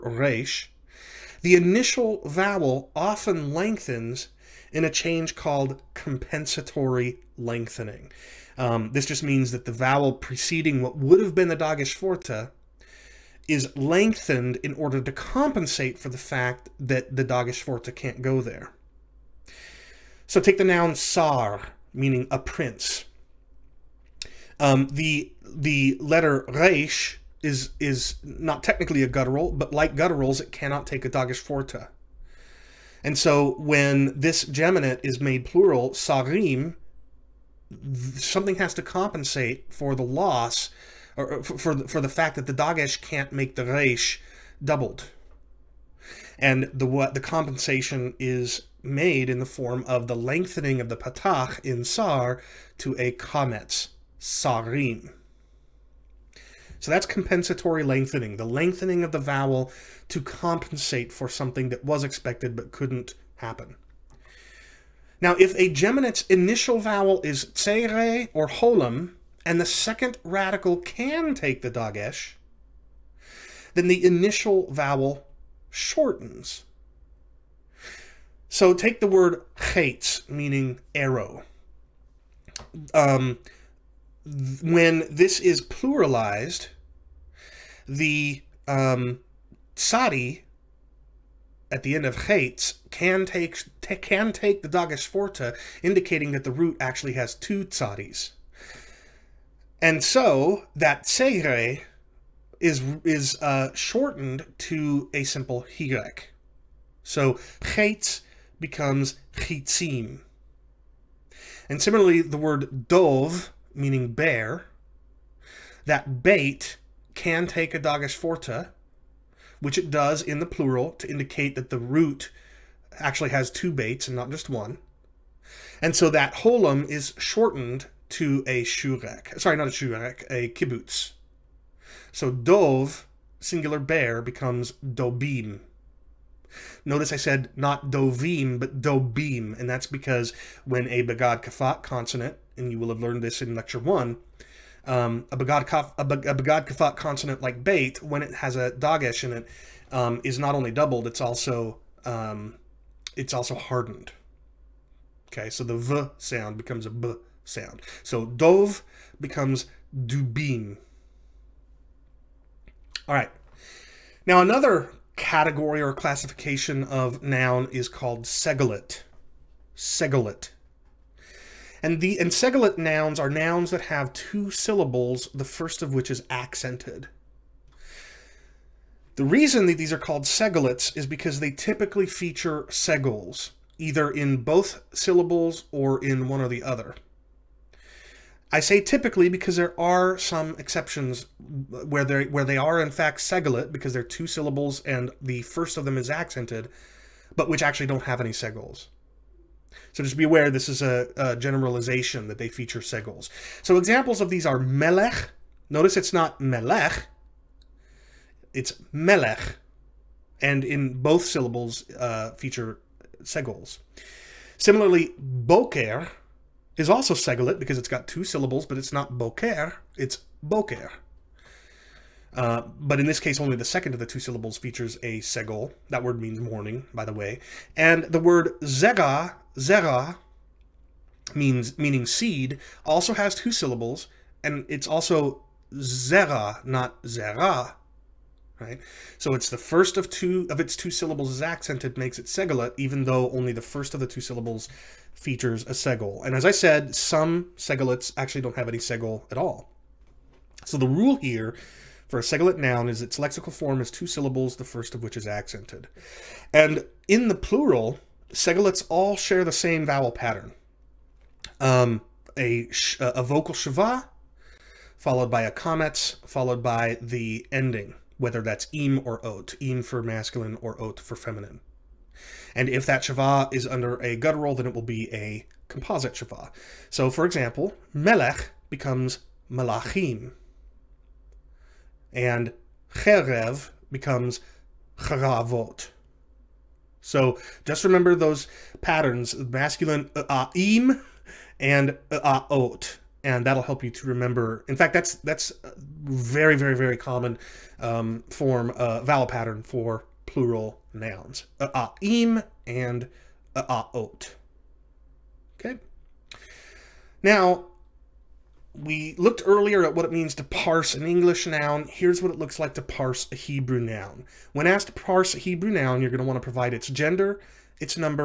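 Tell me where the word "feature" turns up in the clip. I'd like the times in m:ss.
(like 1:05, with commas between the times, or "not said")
3:02, 3:22, 3:32, 3:44, 4:05.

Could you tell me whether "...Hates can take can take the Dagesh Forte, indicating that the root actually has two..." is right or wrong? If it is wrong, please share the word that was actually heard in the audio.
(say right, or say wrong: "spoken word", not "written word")
right.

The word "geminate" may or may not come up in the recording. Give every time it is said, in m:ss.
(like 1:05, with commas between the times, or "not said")
0:34, 1:05.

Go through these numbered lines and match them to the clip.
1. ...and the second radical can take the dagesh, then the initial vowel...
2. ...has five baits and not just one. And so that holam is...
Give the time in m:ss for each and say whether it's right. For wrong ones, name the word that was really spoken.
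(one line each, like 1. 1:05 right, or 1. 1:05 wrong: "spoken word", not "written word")
1. 1:09 right
2. 2:03 wrong: "two", not "five".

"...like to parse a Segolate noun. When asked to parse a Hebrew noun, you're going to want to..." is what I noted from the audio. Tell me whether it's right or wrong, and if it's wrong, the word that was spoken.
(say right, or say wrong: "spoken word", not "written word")
wrong: "Hebrew", not "Segolate".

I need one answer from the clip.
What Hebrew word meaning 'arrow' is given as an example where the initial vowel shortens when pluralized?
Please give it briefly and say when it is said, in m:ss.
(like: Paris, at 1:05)
chaitz, at 1:19.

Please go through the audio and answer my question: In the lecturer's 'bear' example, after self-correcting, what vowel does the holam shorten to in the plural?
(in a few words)
kibbutz.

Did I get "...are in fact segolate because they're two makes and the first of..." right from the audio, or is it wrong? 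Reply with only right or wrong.
wrong.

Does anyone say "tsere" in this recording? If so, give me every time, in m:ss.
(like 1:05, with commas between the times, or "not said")
1:07, 1:41.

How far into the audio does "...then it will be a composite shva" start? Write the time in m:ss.
4:34.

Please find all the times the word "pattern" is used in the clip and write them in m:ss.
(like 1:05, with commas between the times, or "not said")
4:20, 4:48, 4:59.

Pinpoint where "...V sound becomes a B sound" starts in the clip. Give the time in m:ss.
2:35.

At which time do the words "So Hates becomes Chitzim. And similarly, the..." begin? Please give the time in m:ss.
1:47.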